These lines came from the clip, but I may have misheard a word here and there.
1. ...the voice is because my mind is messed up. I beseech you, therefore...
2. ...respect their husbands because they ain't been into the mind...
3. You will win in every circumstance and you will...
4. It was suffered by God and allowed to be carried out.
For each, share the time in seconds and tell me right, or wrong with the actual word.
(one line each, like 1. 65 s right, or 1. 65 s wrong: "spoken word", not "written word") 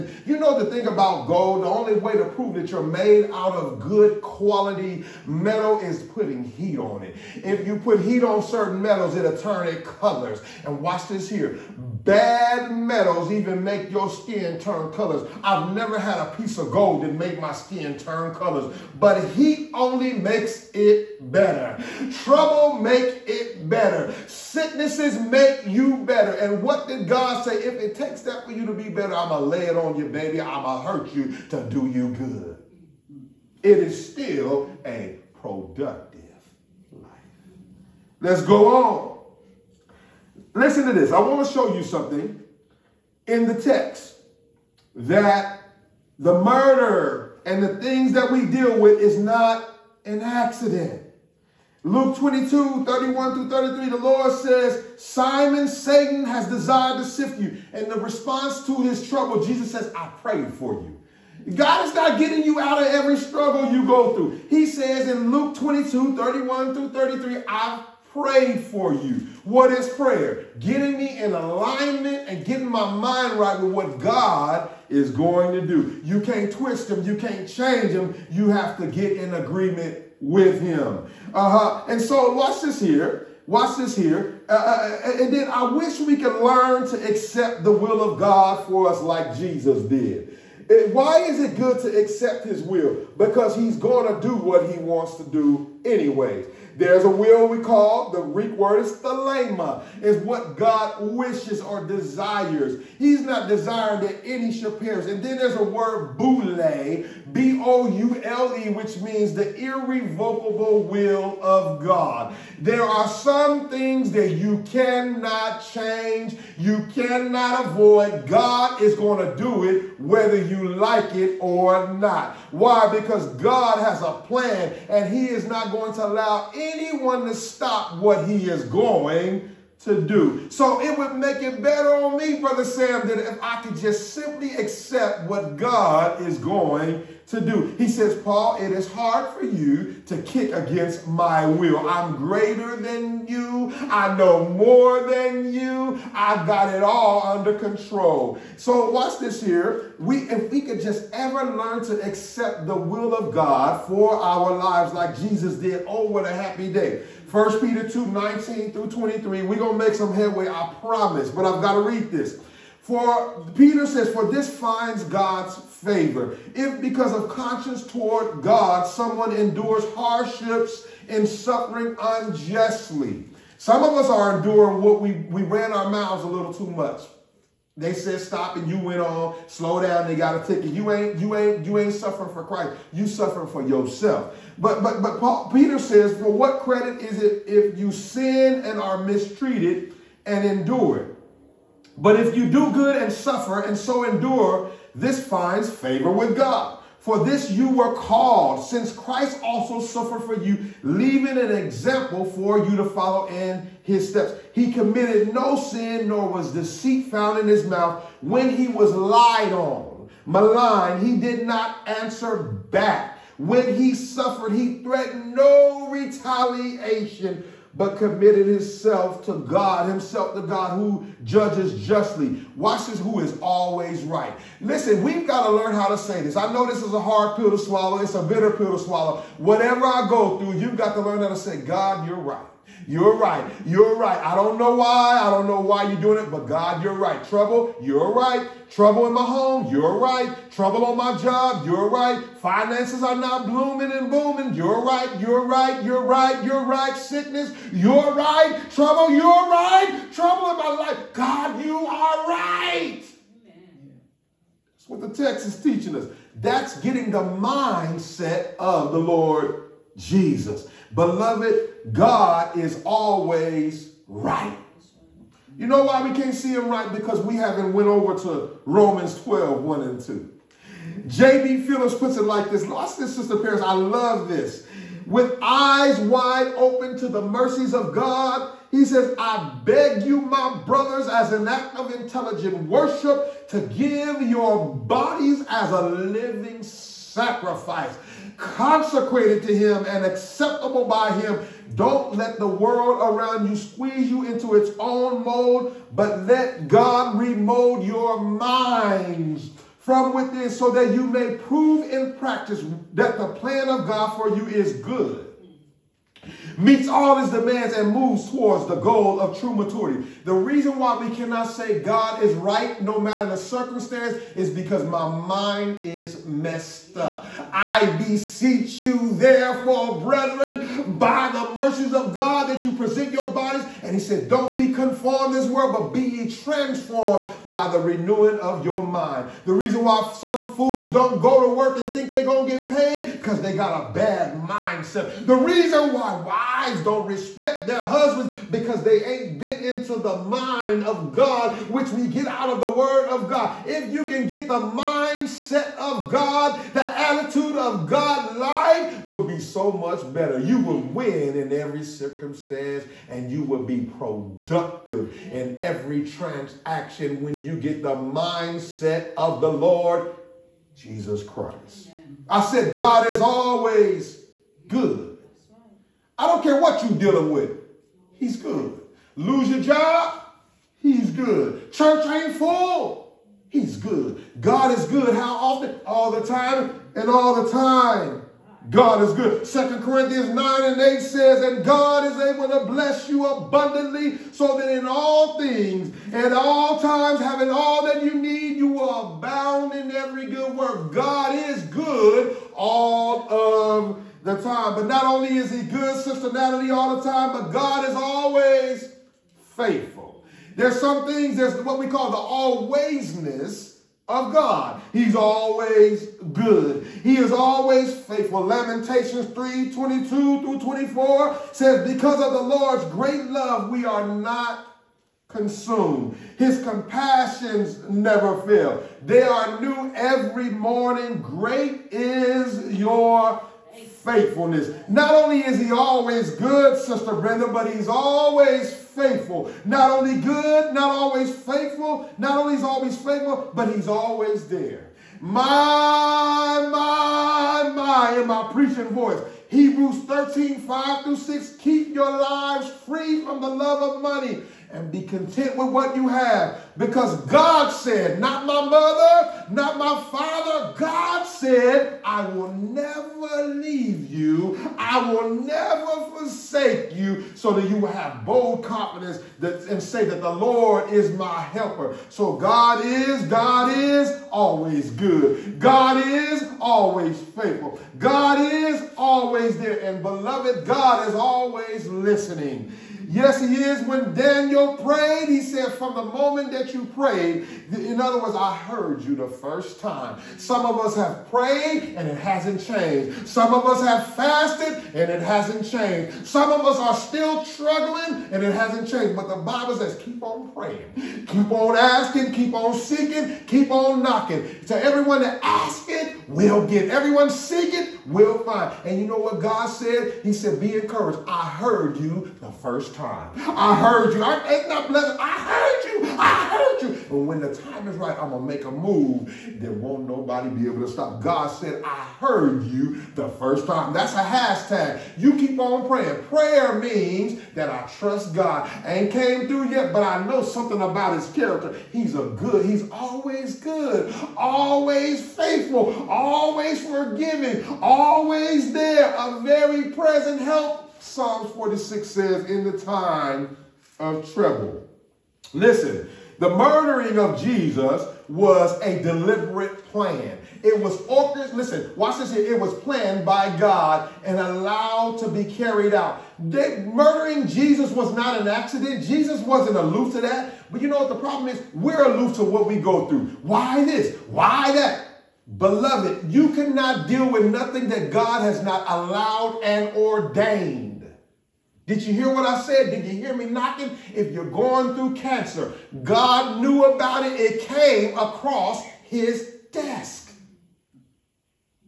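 1. 313 s wrong: "circumstance", not "voice"
2. 337 s right
3. 350 s right
4. 542 s wrong: "planned", not "suffered".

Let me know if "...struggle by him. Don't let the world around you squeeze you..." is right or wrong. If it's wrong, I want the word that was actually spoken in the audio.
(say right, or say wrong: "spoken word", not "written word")
wrong: "acceptable", not "struggle".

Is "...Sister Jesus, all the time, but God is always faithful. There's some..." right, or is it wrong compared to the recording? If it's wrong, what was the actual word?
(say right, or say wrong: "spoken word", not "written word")
wrong: "Natalie", not "Jesus".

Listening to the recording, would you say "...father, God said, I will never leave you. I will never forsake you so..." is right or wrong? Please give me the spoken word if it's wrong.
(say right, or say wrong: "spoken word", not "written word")
right.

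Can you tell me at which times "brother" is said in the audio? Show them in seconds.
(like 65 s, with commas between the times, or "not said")
132 s, 280 s.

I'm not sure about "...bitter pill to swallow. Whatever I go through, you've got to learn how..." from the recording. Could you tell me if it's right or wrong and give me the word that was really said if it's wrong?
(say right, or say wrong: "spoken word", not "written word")
right.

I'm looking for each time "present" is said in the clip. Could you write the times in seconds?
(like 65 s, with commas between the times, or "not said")
322 s, 529 s.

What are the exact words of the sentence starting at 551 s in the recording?
We're aloof to what we go through.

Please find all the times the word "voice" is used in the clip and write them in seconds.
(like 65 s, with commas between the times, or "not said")
438 s.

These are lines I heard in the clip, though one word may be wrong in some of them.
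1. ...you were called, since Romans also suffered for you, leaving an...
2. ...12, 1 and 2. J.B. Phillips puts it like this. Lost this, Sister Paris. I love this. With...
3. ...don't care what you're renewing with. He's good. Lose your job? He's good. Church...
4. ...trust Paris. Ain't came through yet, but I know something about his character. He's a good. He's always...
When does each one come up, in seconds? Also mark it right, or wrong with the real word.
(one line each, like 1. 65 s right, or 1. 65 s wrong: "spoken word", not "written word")
1. 197 s wrong: "Christ", not "Romans"
2. 269 s right
3. 366 s wrong: "dealing", not "renewing"
4. 517 s wrong: "God", not "Paris".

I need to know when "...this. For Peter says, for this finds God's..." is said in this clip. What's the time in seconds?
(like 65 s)
162 s.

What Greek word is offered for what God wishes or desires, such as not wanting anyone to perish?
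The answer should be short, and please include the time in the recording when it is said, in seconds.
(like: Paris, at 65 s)
thelema, at 98 s.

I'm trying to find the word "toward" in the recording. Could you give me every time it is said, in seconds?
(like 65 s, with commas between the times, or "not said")
167 s, 308 s.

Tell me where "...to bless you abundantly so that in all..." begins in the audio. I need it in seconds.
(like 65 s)
382 s.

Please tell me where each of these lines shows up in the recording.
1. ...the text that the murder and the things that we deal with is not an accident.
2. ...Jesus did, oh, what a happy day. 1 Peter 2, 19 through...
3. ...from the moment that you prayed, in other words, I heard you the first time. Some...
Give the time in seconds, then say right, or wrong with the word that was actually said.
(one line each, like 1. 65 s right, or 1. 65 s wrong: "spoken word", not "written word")
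1. 43 s right
2. 155 s right
3. 475 s right.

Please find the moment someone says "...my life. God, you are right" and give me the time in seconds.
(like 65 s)
250 s.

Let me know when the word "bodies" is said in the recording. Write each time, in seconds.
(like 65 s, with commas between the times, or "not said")
284 s, 323 s.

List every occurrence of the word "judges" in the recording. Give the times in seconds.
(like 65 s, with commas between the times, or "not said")
221 s.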